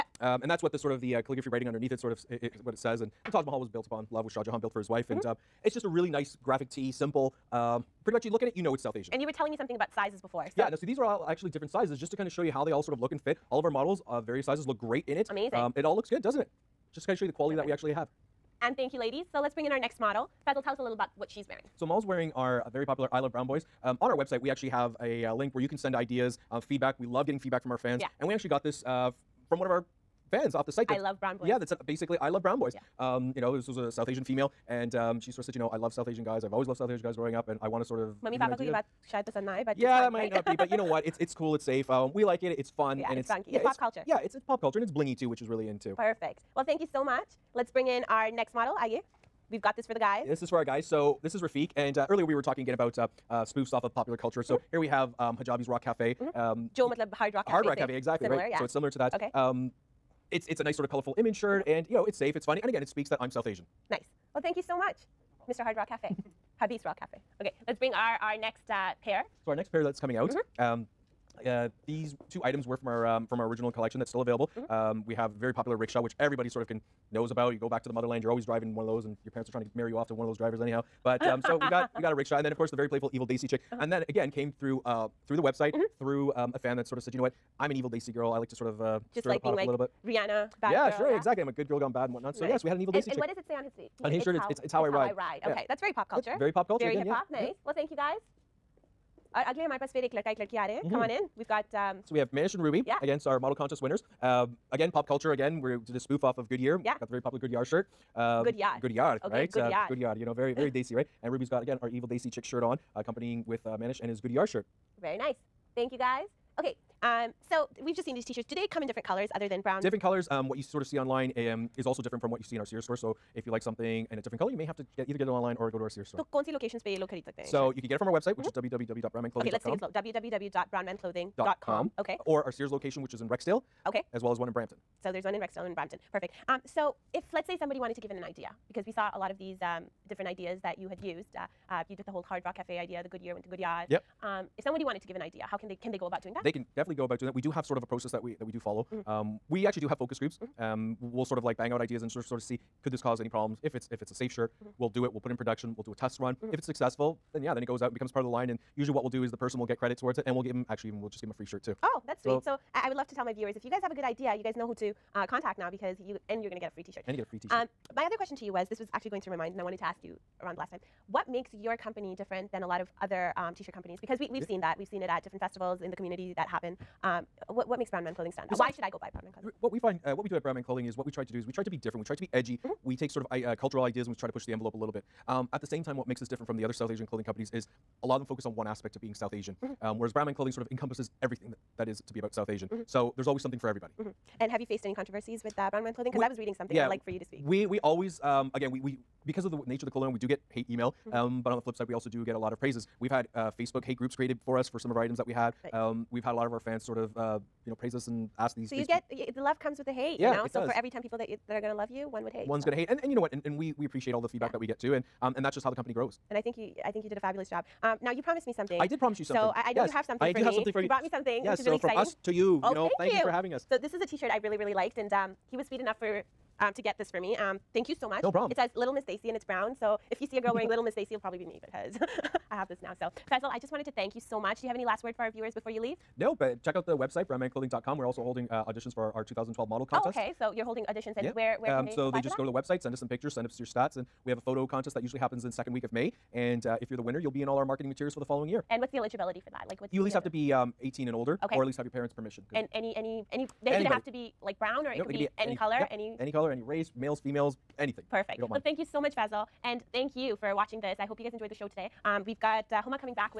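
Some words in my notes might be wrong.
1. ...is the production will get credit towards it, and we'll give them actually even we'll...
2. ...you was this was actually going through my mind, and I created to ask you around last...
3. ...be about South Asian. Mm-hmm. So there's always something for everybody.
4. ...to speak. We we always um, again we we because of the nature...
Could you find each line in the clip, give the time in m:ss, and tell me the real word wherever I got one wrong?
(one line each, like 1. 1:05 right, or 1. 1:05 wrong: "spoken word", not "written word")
1. 2:39 wrong: "person", not "production"
2. 2:48 wrong: "wanted", not "created"
3. 3:12 right
4. 3:17 right.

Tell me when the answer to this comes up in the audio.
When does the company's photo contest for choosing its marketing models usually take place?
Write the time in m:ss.
4:05.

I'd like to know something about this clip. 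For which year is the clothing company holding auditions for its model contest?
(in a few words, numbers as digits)
2012.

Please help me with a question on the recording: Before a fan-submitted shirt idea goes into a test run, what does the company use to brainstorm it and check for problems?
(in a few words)
Focus groups.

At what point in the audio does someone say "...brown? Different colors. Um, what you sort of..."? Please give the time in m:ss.
1:59.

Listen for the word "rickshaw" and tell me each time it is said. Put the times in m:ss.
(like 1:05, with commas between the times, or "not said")
1:15, 1:22.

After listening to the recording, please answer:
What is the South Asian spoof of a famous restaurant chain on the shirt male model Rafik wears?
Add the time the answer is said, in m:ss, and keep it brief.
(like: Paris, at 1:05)
Hijabi's Rock Cafe, at 0:55.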